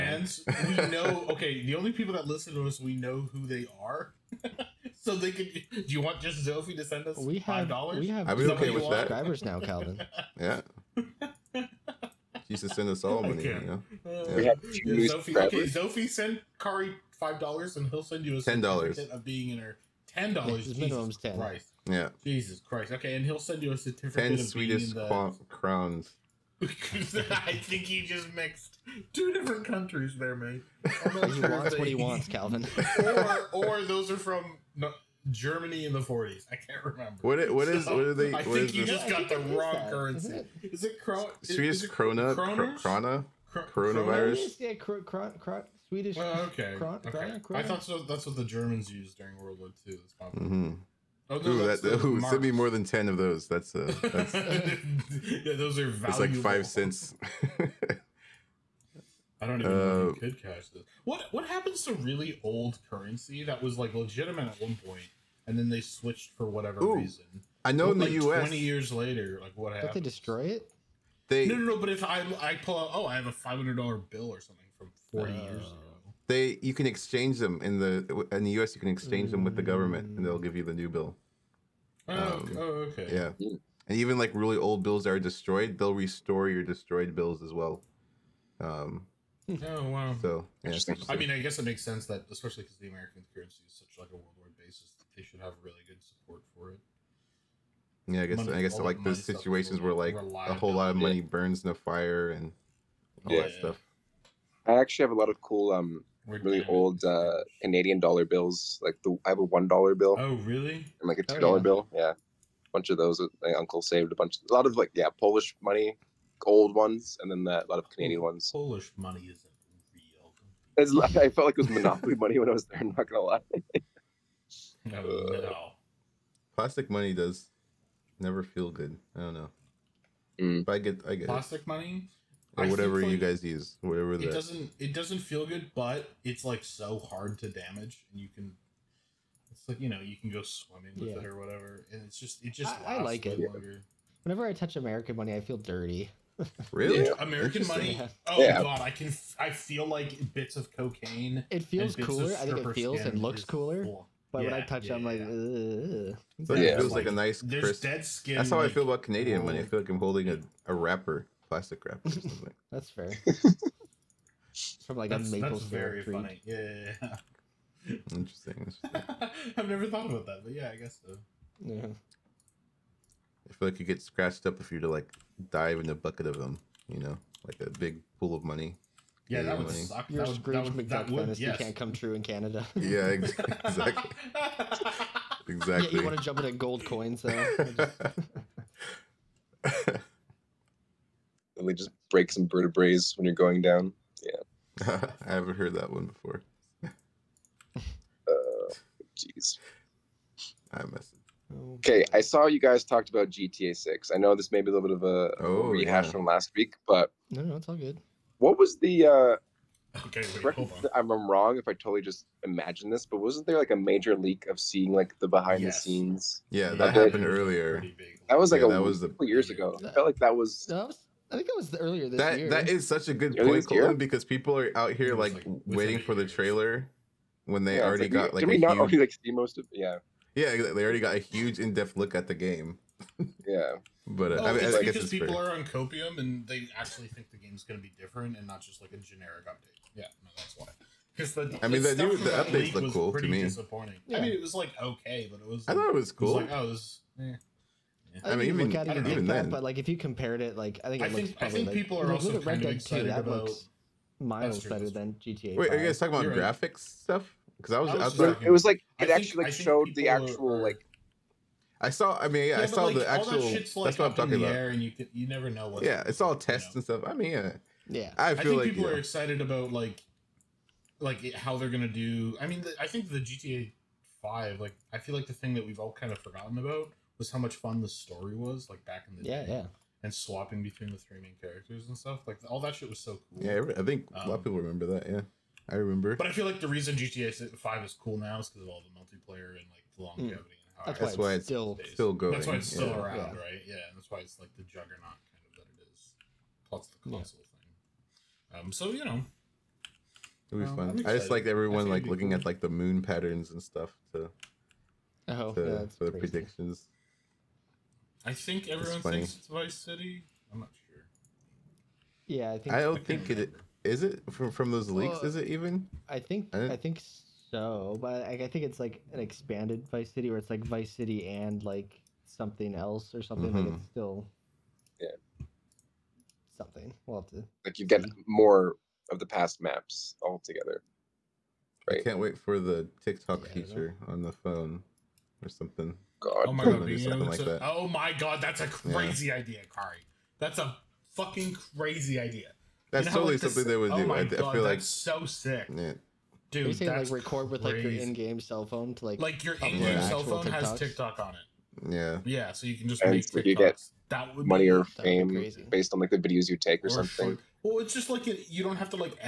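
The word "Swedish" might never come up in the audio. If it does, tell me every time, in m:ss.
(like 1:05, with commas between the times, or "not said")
0:41, 0:45.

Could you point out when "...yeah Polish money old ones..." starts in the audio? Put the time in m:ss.
1:54.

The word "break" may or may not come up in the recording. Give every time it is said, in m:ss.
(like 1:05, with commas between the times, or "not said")
3:12.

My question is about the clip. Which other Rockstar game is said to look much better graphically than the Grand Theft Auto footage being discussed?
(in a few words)
Red Dead 2.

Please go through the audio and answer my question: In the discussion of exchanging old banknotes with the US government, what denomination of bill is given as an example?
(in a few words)
500 dollars.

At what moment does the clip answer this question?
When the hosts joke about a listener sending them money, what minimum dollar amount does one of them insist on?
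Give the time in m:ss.
0:20.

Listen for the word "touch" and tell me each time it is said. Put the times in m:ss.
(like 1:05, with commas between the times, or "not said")
2:24, 2:34.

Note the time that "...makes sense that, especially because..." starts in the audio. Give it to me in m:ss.
1:31.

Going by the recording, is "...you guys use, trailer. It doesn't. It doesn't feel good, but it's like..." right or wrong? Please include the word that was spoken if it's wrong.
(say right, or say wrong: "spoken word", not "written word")
wrong: "whatever", not "trailer".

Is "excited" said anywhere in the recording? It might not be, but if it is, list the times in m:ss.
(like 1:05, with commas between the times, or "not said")
4:28.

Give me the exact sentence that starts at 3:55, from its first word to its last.
are on copium and they actually think the game's going to be different and not just like a generic update.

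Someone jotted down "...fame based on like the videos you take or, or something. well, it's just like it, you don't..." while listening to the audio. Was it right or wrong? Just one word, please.
right.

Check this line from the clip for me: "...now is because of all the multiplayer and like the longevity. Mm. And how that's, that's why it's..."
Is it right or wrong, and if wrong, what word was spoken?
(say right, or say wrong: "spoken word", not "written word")
right.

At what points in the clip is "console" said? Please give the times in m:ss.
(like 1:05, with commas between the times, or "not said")
4:57.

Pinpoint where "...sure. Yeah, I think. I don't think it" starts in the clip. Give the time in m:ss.
5:10.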